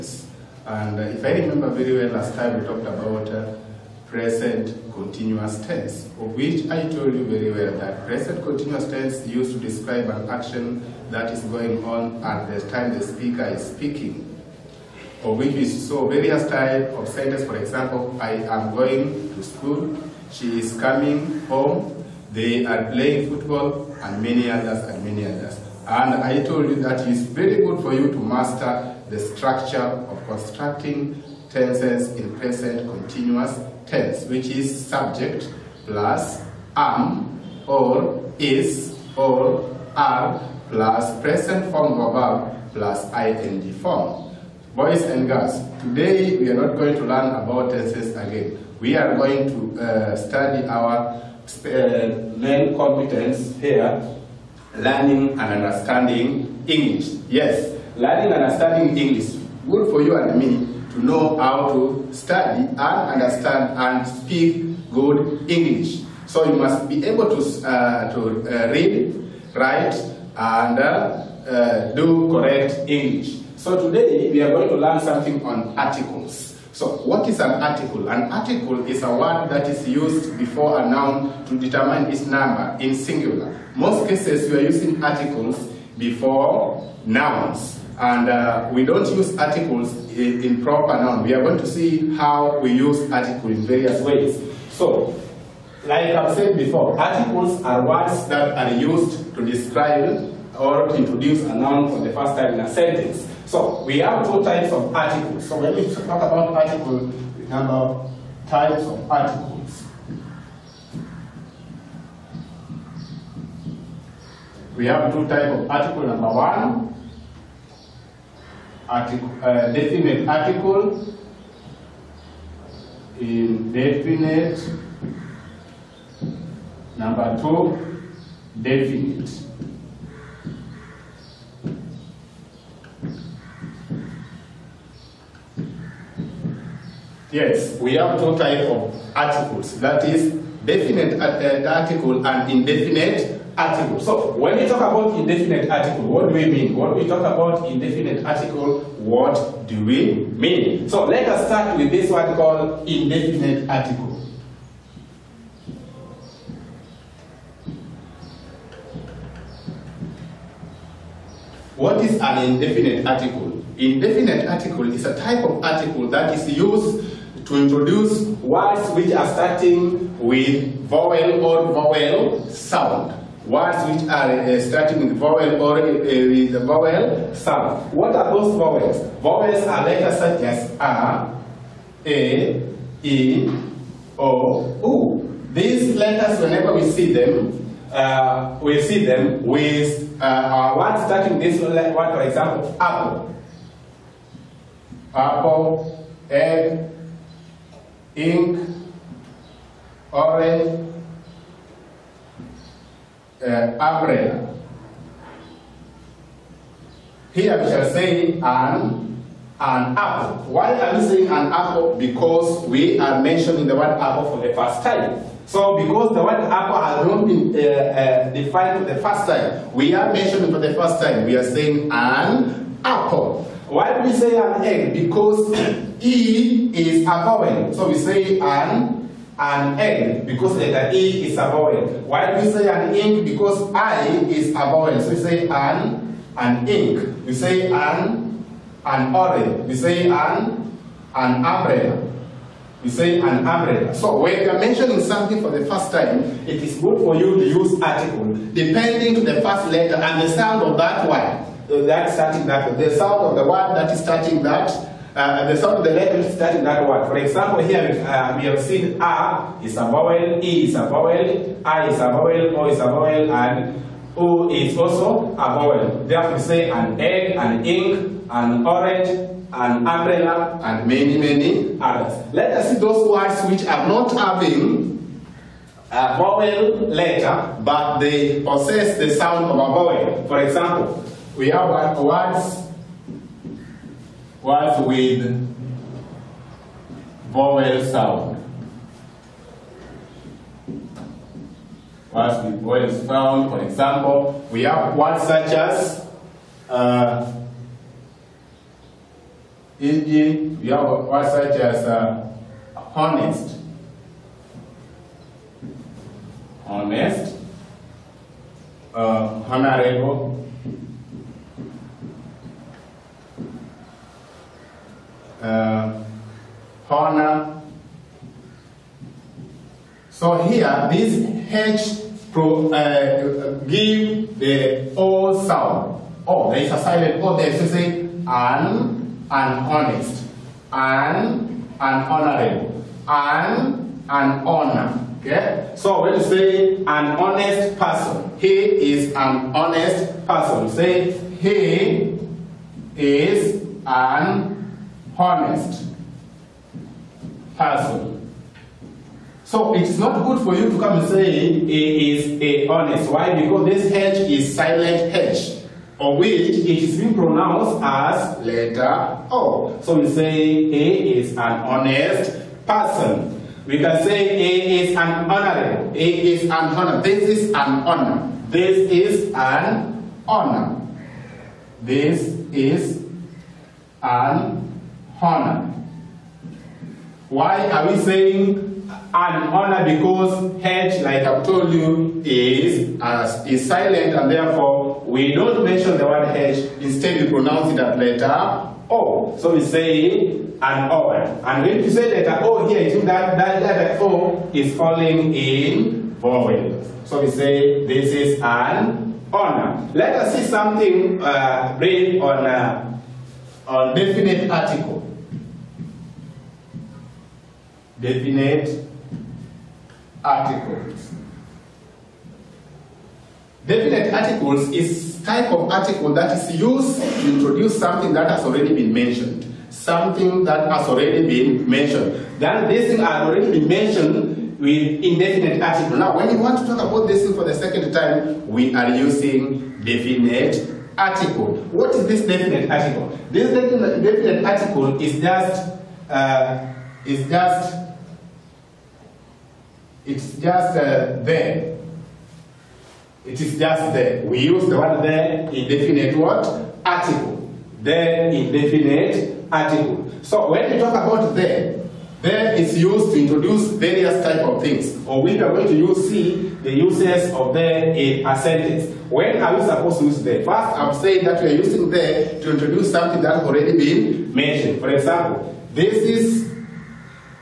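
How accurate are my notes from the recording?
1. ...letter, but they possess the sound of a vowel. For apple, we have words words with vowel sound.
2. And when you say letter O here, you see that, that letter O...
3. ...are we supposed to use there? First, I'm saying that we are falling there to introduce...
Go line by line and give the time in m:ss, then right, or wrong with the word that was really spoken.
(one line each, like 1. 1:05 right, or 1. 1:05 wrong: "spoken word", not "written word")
1. 4:36 wrong: "example", not "apple"
2. 6:31 right
3. 7:39 wrong: "using", not "falling".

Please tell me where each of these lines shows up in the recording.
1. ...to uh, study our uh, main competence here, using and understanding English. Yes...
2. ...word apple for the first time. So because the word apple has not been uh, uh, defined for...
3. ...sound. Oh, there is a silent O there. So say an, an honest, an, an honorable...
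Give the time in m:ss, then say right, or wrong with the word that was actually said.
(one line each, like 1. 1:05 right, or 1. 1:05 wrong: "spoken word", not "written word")
1. 0:49 wrong: "learning", not "using"
2. 3:33 right
3. 5:25 right.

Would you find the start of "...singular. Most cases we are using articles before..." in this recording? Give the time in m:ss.
1:22.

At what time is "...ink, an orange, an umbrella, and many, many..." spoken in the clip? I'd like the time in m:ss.
4:27.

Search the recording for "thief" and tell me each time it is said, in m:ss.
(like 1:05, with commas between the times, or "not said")
not said.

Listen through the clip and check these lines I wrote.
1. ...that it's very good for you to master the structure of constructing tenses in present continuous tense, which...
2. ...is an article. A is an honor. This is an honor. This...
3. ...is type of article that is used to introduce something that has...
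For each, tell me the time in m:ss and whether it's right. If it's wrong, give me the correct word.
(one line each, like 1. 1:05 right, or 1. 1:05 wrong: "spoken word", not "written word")
1. 0:26 right
2. 6:04 wrong: "honorable", not "article"
3. 6:54 right.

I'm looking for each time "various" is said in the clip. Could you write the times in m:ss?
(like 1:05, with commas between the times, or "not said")
0:16, 1:33, 7:33.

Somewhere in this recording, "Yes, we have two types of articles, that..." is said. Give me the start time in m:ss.
2:17.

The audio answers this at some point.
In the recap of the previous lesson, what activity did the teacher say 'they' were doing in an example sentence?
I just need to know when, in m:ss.
0:22.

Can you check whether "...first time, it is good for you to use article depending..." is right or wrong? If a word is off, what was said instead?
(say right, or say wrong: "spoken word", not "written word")
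right.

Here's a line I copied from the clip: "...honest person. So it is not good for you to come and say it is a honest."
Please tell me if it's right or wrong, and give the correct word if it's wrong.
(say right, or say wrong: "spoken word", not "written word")
right.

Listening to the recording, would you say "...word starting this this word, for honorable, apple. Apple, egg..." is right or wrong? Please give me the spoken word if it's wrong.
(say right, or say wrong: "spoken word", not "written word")
wrong: "example", not "honorable".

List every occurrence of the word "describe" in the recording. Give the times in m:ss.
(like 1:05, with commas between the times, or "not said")
0:09, 1:39.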